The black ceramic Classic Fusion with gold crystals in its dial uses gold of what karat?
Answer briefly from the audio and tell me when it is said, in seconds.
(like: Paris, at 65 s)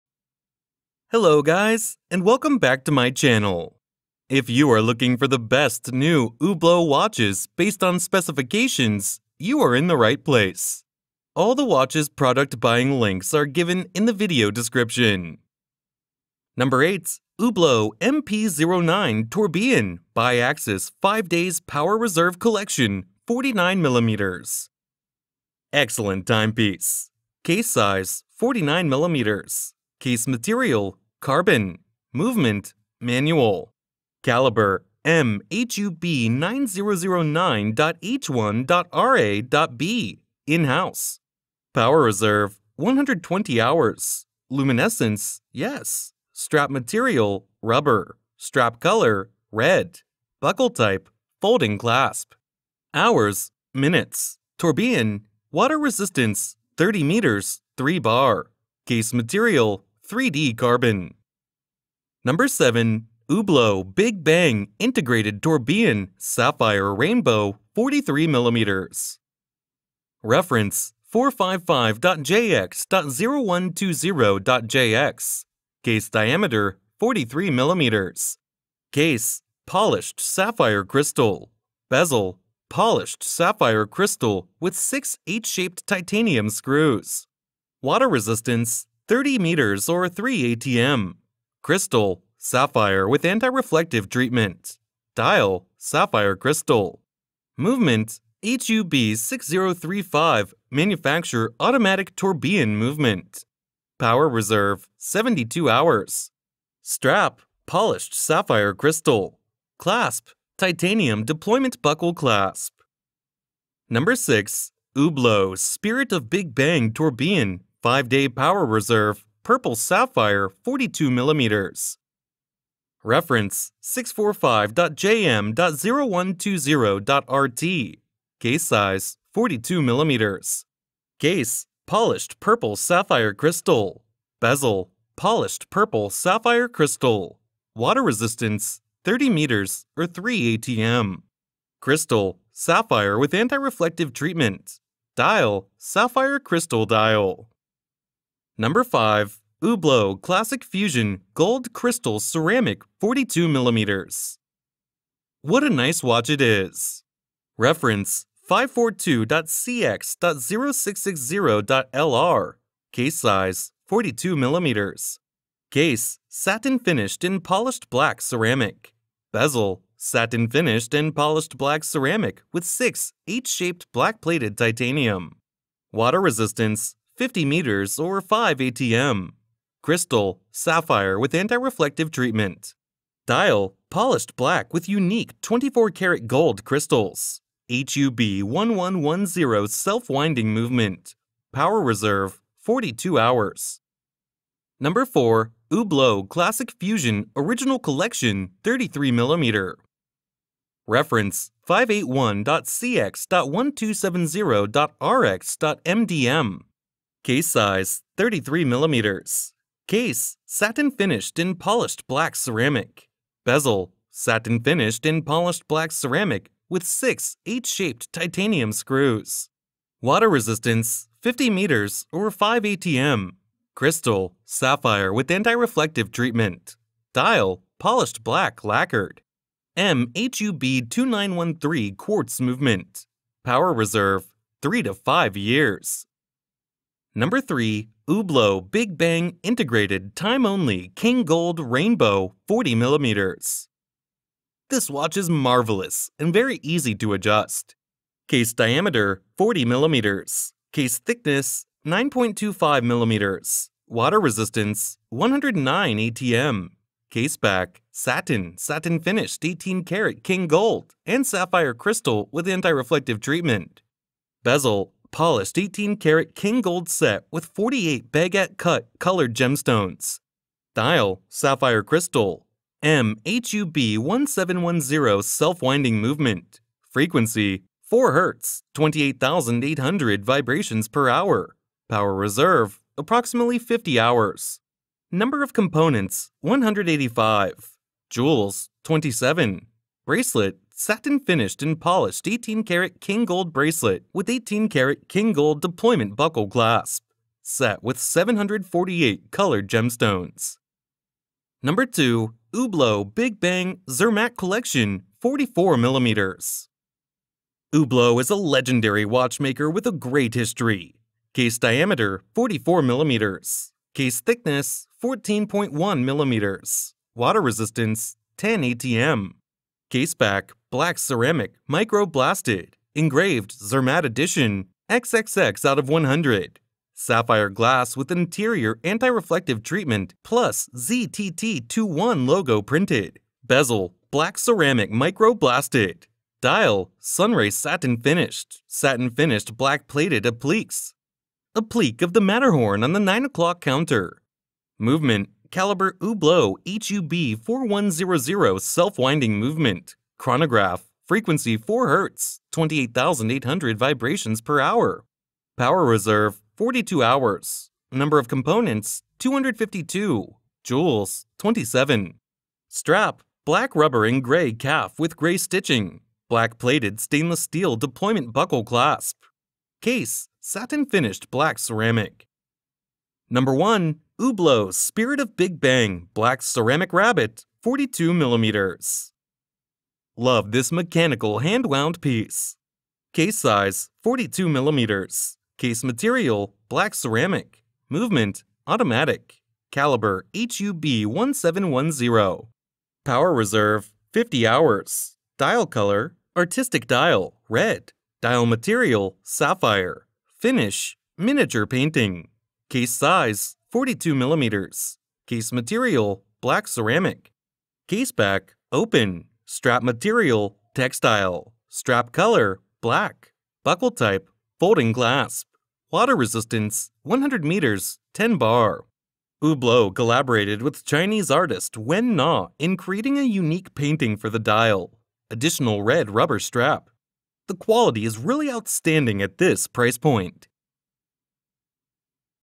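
24 karat, at 185 s.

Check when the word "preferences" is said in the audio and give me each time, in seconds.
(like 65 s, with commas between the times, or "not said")
not said.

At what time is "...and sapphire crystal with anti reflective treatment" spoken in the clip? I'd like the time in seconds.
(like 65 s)
261 s.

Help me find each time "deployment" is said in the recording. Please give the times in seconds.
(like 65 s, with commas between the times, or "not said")
111 s, 295 s, 367 s.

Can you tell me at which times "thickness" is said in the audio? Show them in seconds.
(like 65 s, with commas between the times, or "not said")
250 s, 314 s.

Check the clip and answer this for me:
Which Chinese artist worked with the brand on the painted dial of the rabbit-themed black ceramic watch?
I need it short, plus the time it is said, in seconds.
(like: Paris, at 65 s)
Wen Na, at 421 s.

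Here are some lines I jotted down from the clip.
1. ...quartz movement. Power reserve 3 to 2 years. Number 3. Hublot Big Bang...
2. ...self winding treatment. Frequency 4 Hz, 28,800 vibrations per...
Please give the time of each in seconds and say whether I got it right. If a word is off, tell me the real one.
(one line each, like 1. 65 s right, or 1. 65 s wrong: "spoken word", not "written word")
1. 231 s wrong: "5", not "2"
2. 275 s wrong: "movement", not "treatment".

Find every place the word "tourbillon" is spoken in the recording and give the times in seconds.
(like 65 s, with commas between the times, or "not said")
19 s, 54 s, 65 s, 102 s, 116 s.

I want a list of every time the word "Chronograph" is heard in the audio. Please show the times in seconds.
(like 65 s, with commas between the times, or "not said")
350 s.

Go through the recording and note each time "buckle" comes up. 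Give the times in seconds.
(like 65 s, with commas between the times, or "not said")
50 s, 111 s, 296 s, 368 s, 413 s.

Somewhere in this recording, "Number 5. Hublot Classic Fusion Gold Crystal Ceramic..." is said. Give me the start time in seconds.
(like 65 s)
148 s.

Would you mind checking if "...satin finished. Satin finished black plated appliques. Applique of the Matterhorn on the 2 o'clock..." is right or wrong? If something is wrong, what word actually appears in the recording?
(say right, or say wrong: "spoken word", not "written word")
wrong: "9", not "2".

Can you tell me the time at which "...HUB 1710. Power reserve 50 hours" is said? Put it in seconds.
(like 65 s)
390 s.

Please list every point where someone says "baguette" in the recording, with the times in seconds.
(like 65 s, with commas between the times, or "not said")
268 s.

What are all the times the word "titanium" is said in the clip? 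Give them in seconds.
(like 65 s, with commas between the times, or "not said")
85 s, 110 s, 174 s, 218 s.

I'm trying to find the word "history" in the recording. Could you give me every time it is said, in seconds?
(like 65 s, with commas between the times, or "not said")
310 s.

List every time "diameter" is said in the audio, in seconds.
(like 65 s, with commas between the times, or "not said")
76 s, 248 s, 311 s.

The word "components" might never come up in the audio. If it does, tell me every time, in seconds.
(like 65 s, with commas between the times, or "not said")
285 s, 358 s.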